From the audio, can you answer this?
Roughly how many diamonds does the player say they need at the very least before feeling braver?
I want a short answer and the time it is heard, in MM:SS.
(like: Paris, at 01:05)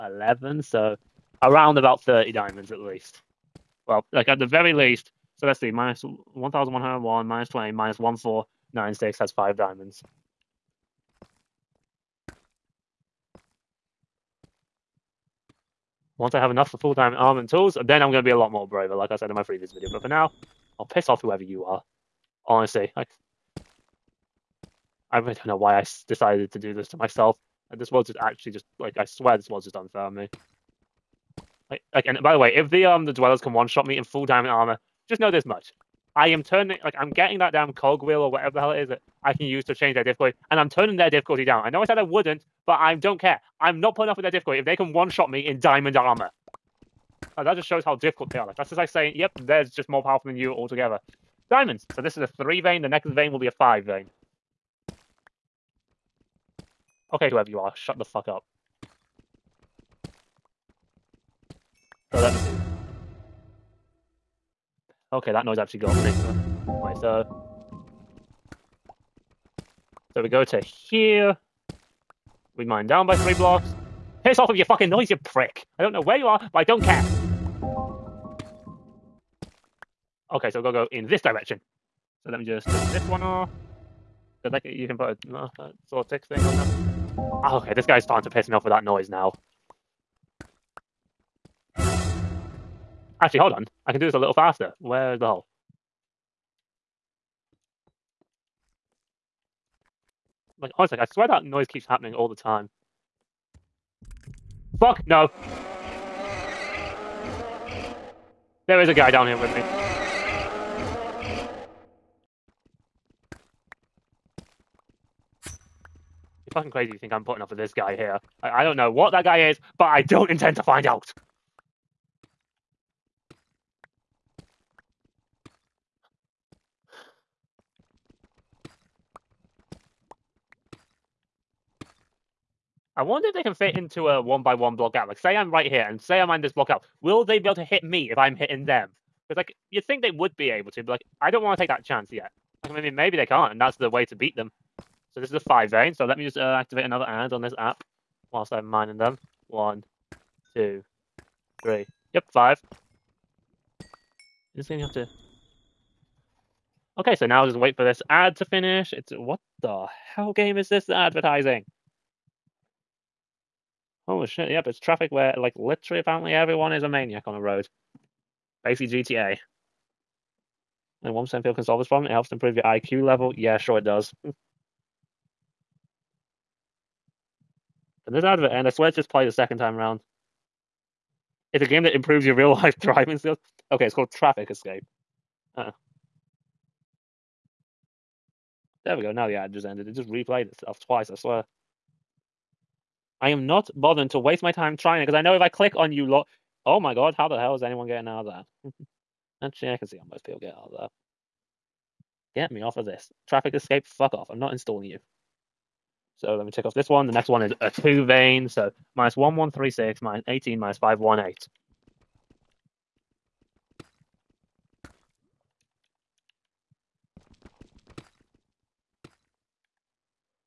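30, at 00:02.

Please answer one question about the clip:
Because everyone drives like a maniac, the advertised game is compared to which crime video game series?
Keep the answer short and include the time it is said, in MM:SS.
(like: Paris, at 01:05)
GTA, at 02:48.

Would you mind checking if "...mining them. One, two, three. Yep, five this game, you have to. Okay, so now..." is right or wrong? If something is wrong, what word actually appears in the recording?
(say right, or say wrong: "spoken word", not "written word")
right.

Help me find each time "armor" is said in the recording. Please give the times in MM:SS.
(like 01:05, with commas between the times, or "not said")
00:34, 00:45.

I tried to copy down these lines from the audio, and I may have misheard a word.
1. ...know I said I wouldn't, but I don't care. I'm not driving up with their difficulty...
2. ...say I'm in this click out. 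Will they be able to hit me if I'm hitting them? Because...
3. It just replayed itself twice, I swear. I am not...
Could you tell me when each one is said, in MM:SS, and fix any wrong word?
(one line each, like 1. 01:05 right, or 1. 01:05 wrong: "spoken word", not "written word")
1. 00:41 wrong: "putting", not "driving"
2. 02:15 wrong: "block", not "click"
3. 03:09 right.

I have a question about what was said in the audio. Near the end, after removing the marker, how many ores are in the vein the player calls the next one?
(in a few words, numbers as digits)
2.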